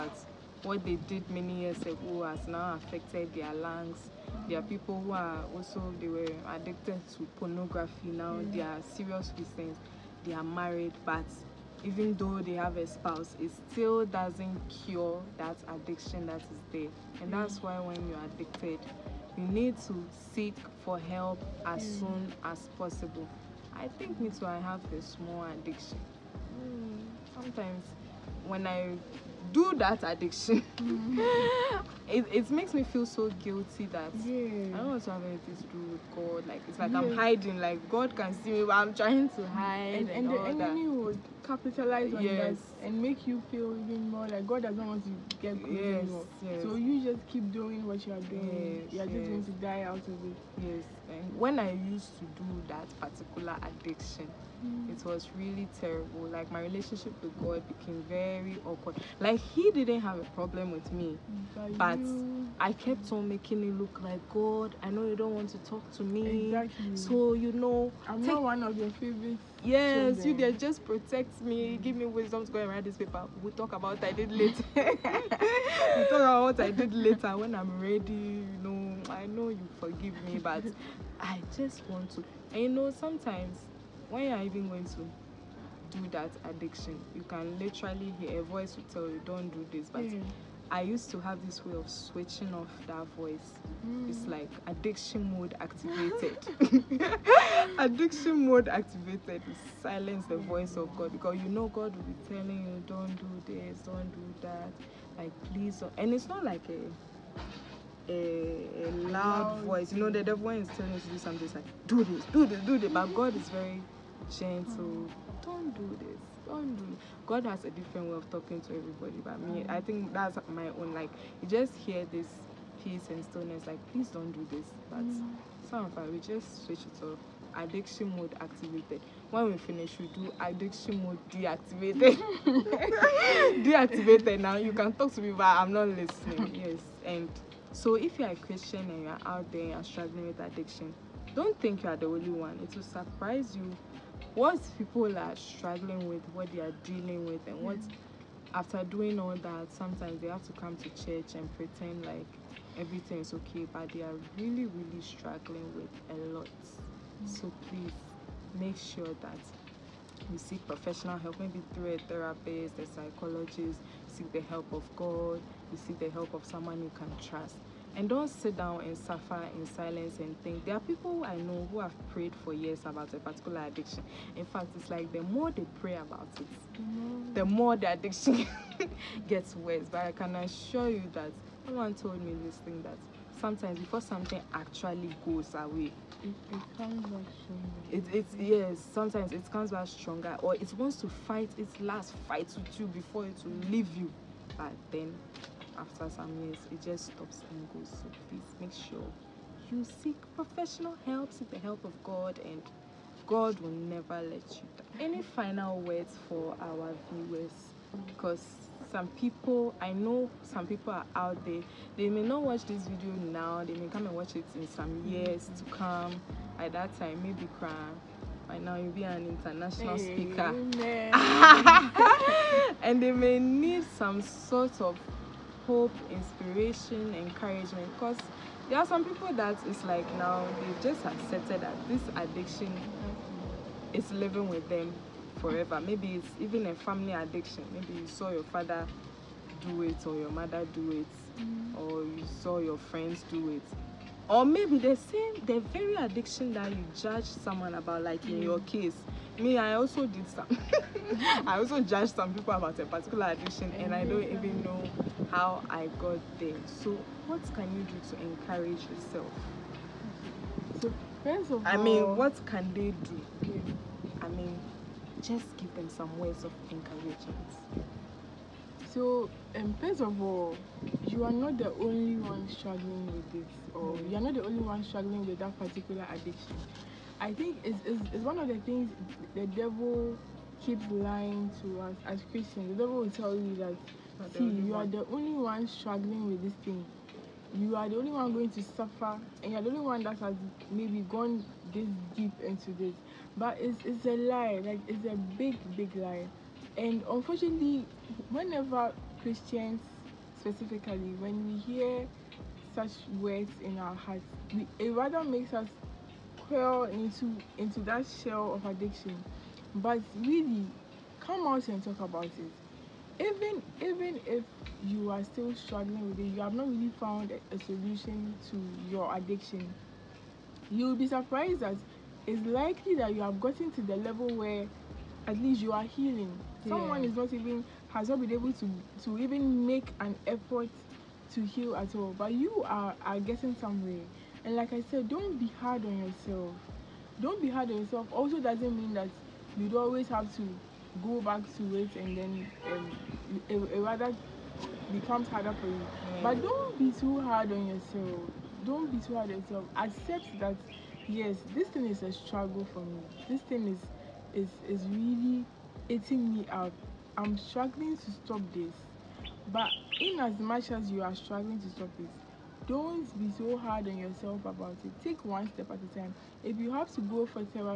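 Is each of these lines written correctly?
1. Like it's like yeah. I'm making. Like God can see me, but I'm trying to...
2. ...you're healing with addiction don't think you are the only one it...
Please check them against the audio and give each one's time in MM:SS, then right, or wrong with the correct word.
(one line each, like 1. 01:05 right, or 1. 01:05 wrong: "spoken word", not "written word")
1. 00:36 wrong: "hiding", not "making"
2. 02:19 wrong: "struggling", not "healing".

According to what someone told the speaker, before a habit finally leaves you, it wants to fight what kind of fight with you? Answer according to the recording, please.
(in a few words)
its last fight.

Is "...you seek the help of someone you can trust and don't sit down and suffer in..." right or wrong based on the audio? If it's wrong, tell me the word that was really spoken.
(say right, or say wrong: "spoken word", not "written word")
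right.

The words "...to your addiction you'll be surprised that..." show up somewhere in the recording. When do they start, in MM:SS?
05:18.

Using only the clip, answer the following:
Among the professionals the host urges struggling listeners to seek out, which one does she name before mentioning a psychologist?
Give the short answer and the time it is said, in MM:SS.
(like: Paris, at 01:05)
a therapist, at 02:41.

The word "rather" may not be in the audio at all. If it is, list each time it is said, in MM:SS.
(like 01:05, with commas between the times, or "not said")
05:04, 05:43.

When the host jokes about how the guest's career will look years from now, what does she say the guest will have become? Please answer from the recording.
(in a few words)
an international speaker.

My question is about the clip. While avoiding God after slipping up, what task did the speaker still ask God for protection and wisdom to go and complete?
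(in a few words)
write this paper.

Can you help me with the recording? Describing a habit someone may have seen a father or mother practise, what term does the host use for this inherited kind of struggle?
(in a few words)
a family addiction.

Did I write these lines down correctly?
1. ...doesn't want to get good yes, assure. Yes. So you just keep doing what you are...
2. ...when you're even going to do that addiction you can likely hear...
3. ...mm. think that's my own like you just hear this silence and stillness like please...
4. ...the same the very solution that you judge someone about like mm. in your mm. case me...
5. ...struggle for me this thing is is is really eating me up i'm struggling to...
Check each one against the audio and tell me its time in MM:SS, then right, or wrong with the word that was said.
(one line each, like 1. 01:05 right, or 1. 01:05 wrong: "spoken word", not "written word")
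1. 00:44 wrong: "anymore", not "assure"
2. 01:24 wrong: "literally", not "likely"
3. 01:59 wrong: "peace", not "silence"
4. 04:04 wrong: "addiction", not "solution"
5. 05:52 right.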